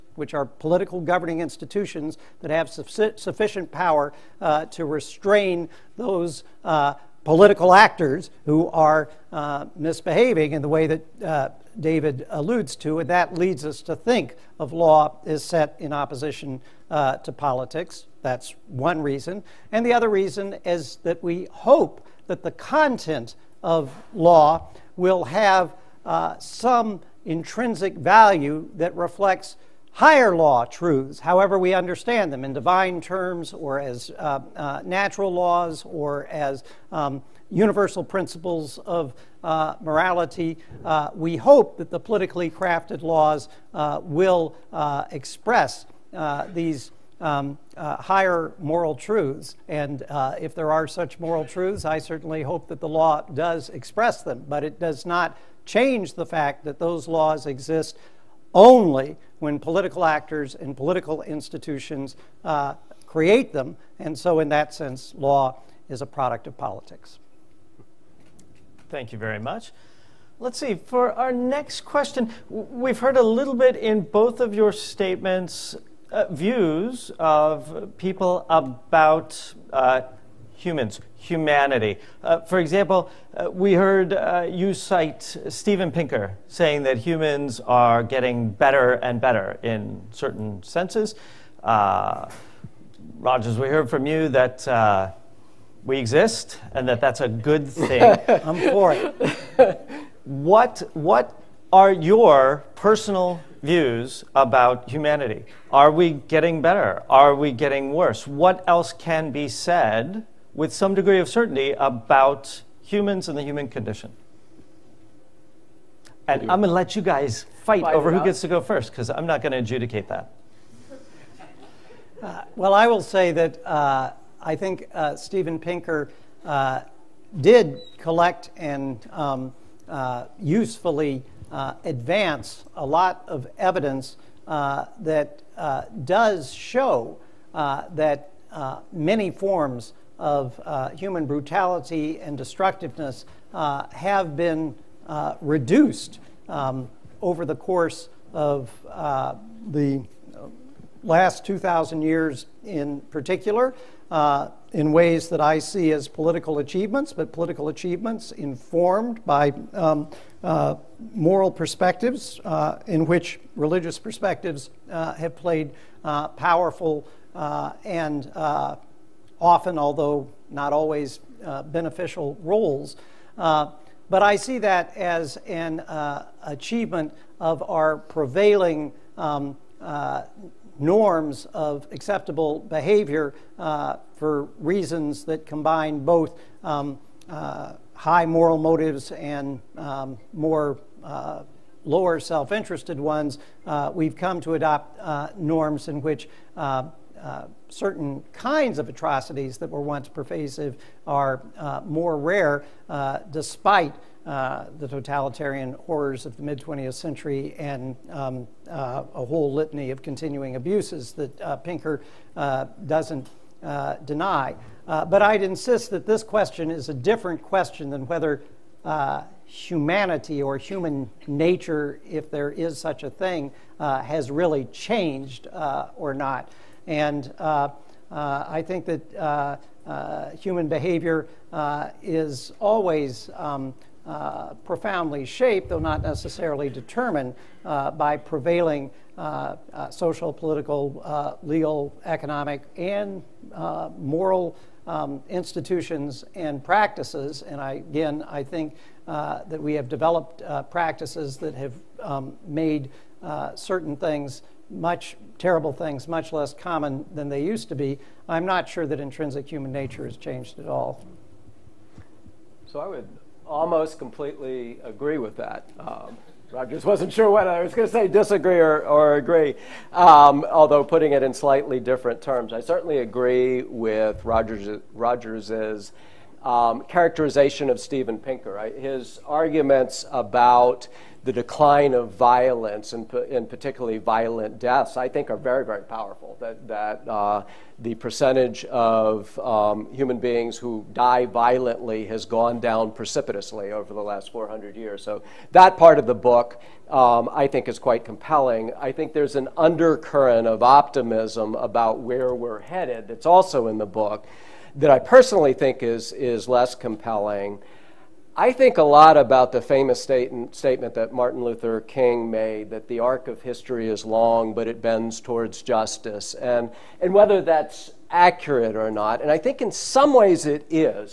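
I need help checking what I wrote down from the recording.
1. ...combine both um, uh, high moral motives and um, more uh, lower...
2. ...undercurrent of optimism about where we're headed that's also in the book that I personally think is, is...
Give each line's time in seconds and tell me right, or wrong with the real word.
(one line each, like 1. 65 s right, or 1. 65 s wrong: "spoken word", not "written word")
1. 185 s right
2. 299 s right.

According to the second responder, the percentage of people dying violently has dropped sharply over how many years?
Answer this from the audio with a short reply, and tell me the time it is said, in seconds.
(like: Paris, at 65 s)
400 years, at 294 s.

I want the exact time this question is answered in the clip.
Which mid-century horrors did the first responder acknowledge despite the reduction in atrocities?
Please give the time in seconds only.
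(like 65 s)
204 s.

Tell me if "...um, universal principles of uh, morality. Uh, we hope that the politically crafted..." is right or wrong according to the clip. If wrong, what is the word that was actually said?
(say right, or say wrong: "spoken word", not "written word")
right.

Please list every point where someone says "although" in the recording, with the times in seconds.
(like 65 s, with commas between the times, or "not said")
169 s, 270 s.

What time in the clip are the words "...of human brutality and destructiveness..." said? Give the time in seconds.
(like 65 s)
140 s.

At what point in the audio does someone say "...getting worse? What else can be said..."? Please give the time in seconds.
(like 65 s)
107 s.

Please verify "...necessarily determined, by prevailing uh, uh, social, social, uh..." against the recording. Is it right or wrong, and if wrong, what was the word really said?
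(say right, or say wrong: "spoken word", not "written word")
wrong: "political", not "social".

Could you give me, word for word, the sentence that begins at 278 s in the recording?
His arguments about the decline of violence and, and particularly violent deaths, I think are very, very powerful.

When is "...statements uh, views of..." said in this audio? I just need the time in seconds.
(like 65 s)
74 s.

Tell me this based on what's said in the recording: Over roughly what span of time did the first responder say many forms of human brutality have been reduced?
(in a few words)
2,000 years.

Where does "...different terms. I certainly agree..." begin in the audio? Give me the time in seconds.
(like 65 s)
271 s.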